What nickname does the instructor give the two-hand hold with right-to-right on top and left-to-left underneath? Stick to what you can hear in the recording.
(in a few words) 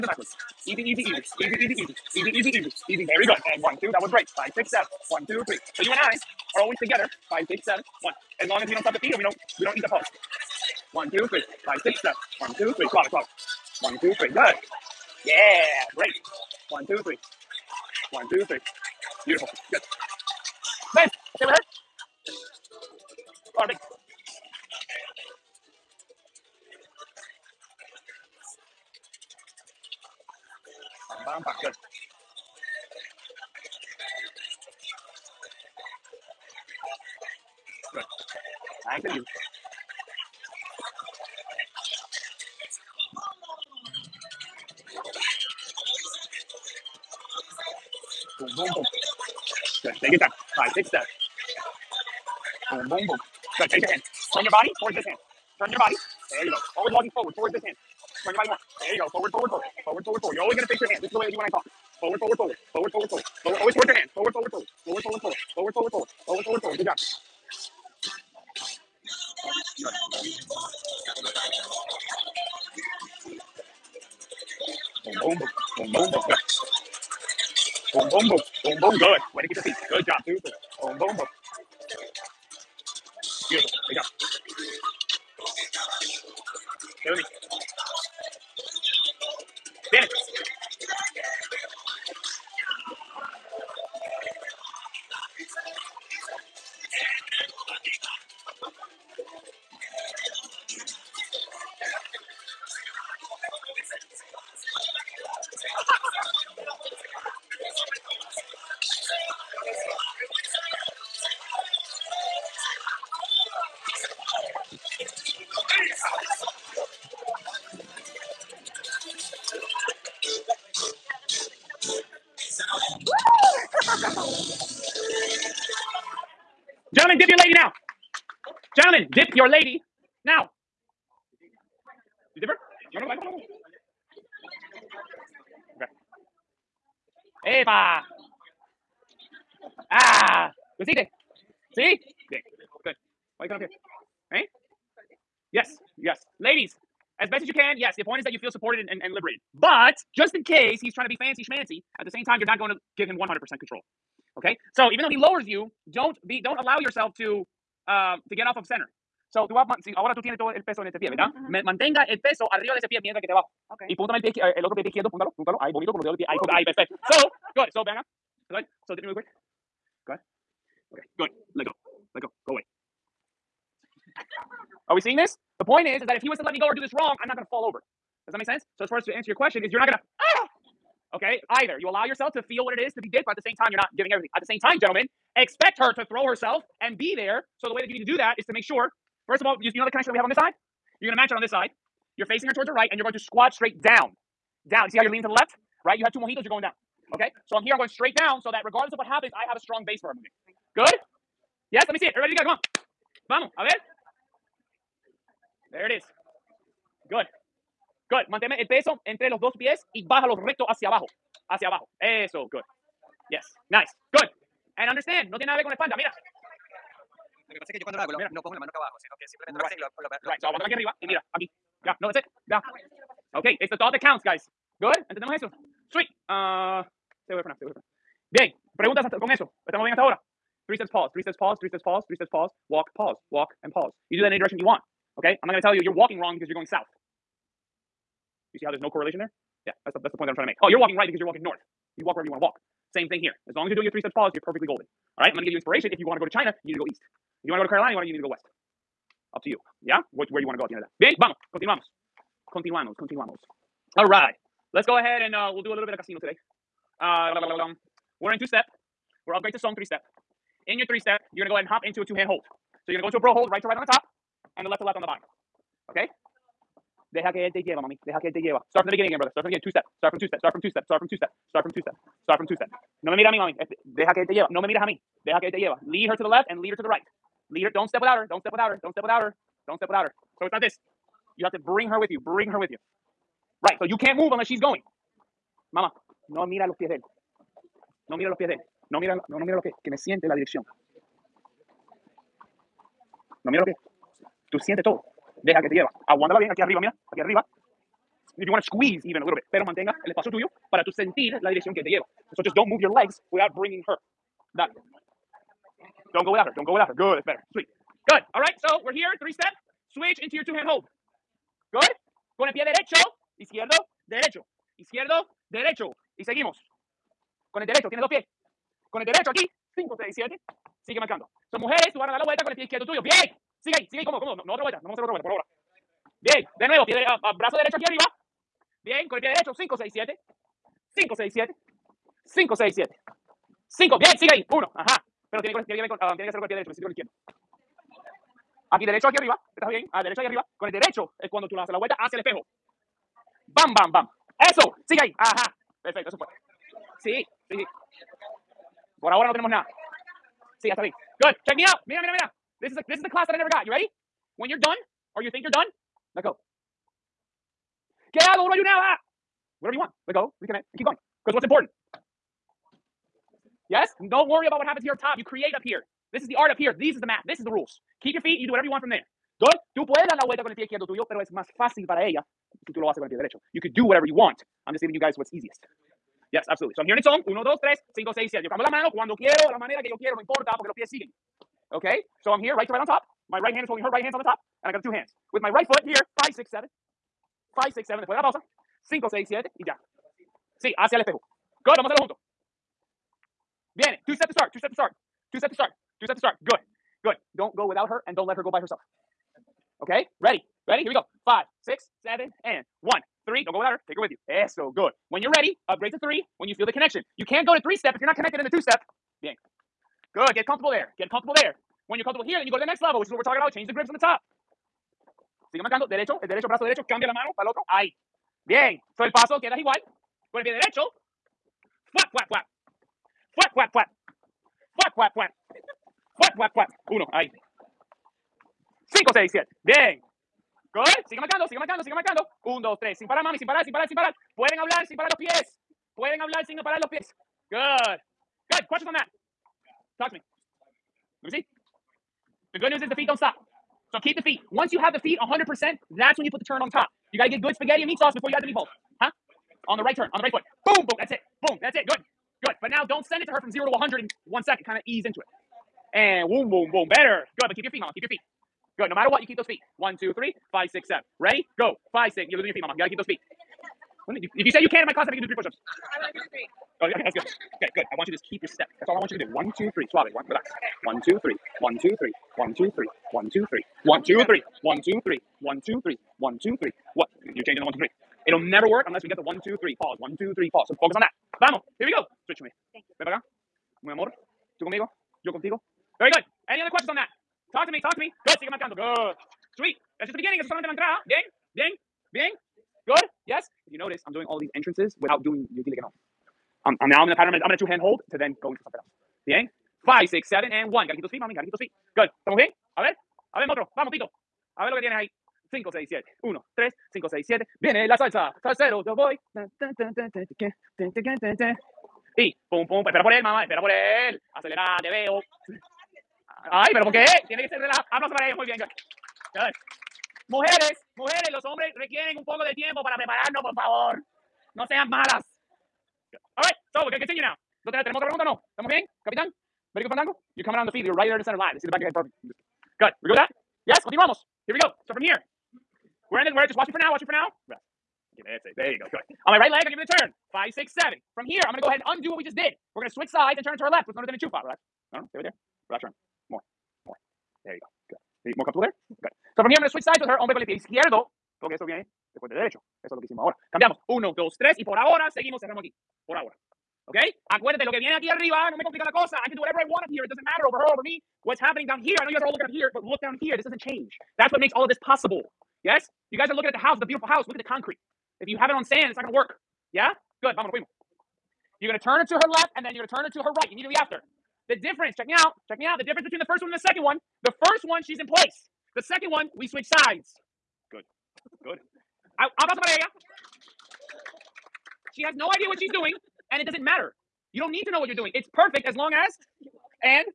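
Bro hold.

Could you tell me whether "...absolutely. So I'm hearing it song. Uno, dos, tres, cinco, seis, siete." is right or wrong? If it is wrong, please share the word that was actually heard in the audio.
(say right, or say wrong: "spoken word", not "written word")
right.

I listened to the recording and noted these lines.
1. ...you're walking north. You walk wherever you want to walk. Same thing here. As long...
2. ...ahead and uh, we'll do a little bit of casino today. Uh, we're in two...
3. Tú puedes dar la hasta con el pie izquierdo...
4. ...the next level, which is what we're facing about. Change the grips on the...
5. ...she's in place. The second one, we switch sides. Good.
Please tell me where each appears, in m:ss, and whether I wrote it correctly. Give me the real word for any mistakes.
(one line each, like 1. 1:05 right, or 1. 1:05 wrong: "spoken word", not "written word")
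1. 4:01 right
2. 4:14 right
3. 6:09 wrong: "vuelta", not "hasta"
4. 6:52 wrong: "talking", not "facing"
5. 9:37 right.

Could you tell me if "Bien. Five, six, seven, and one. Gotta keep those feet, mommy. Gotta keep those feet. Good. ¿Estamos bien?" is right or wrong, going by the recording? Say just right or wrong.
right.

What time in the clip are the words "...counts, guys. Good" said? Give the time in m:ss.
3:44.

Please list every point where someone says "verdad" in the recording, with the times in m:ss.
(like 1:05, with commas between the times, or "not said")
2:41.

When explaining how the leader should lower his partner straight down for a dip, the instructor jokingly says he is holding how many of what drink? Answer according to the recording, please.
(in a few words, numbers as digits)
2 mojitos.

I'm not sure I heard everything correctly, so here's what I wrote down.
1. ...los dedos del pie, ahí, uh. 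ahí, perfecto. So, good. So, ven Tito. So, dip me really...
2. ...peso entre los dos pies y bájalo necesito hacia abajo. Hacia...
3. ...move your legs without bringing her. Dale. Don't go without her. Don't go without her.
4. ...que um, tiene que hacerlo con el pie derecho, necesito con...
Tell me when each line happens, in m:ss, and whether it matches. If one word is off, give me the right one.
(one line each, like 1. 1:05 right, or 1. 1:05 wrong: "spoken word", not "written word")
1. 2:45 wrong: "Good", not "Tito"
2. 3:28 wrong: "recto", not "necesito"
3. 5:02 right
4. 5:35 right.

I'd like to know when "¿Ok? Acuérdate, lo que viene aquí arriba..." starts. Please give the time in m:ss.
9:16.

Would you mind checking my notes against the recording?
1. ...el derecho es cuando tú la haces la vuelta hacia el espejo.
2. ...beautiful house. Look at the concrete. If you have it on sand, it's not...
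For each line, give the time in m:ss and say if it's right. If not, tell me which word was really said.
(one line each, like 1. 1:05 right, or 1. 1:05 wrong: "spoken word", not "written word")
1. 5:40 right
2. 9:26 right.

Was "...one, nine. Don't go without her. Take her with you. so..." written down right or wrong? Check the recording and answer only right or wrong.
wrong.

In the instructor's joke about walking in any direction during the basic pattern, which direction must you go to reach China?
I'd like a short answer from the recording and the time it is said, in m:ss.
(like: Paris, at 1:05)
East, at 4:06.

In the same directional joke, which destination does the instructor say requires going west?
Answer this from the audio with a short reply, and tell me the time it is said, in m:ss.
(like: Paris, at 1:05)
Carolina, at 4:07.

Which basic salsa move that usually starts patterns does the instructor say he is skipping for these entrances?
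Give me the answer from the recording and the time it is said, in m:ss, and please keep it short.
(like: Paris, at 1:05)
Dile que no, at 8:15.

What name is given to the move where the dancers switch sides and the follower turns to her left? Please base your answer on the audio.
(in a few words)
Enchufa.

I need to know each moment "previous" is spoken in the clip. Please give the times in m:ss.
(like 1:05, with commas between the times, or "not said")
not said.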